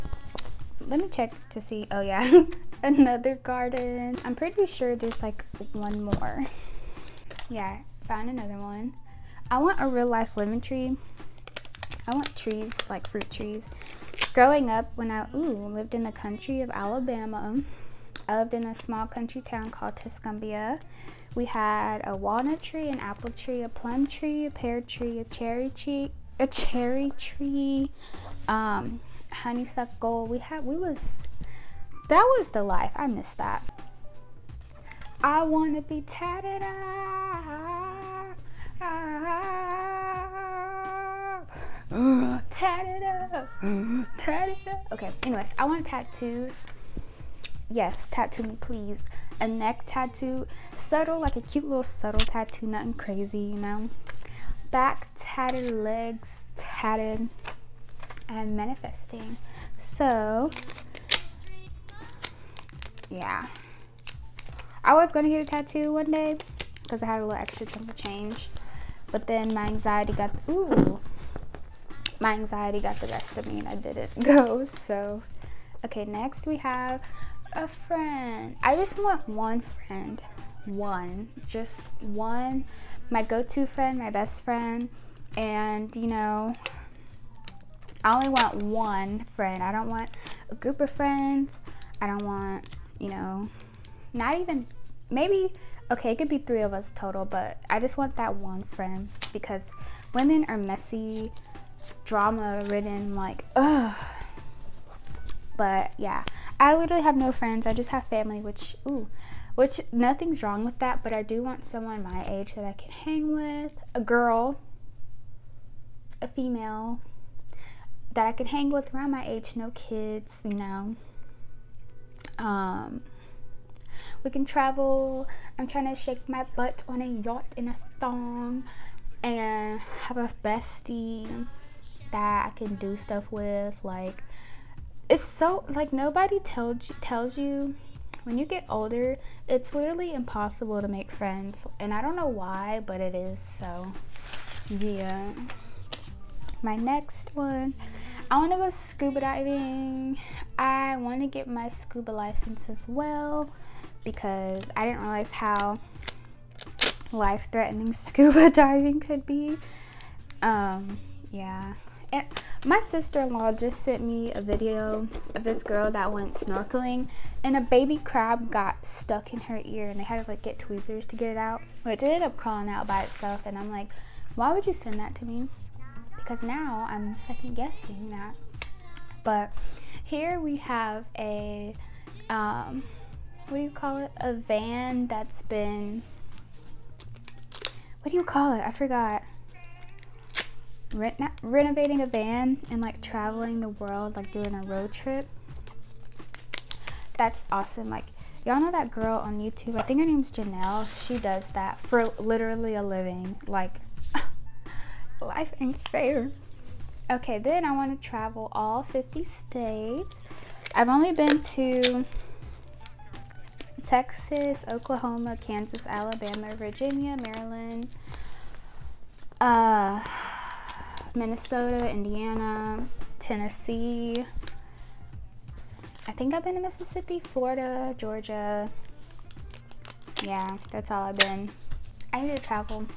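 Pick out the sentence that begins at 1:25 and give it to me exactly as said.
And, you know, I only want one friend.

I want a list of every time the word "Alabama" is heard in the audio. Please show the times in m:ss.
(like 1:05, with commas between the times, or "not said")
0:16, 3:35.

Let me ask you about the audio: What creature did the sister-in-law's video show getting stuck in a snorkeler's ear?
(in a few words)
baby crab.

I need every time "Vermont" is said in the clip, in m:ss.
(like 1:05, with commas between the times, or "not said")
not said.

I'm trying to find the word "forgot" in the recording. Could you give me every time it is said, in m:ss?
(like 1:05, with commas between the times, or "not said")
3:08.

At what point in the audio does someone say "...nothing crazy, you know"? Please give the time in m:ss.
0:52.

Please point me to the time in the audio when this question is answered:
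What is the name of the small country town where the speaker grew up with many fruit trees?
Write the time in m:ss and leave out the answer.
0:19.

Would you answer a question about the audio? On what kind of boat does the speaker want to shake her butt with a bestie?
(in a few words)
yacht.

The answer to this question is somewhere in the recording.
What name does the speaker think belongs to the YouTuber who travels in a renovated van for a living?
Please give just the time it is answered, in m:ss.
3:20.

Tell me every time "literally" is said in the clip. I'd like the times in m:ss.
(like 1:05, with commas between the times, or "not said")
1:46, 2:19, 3:22.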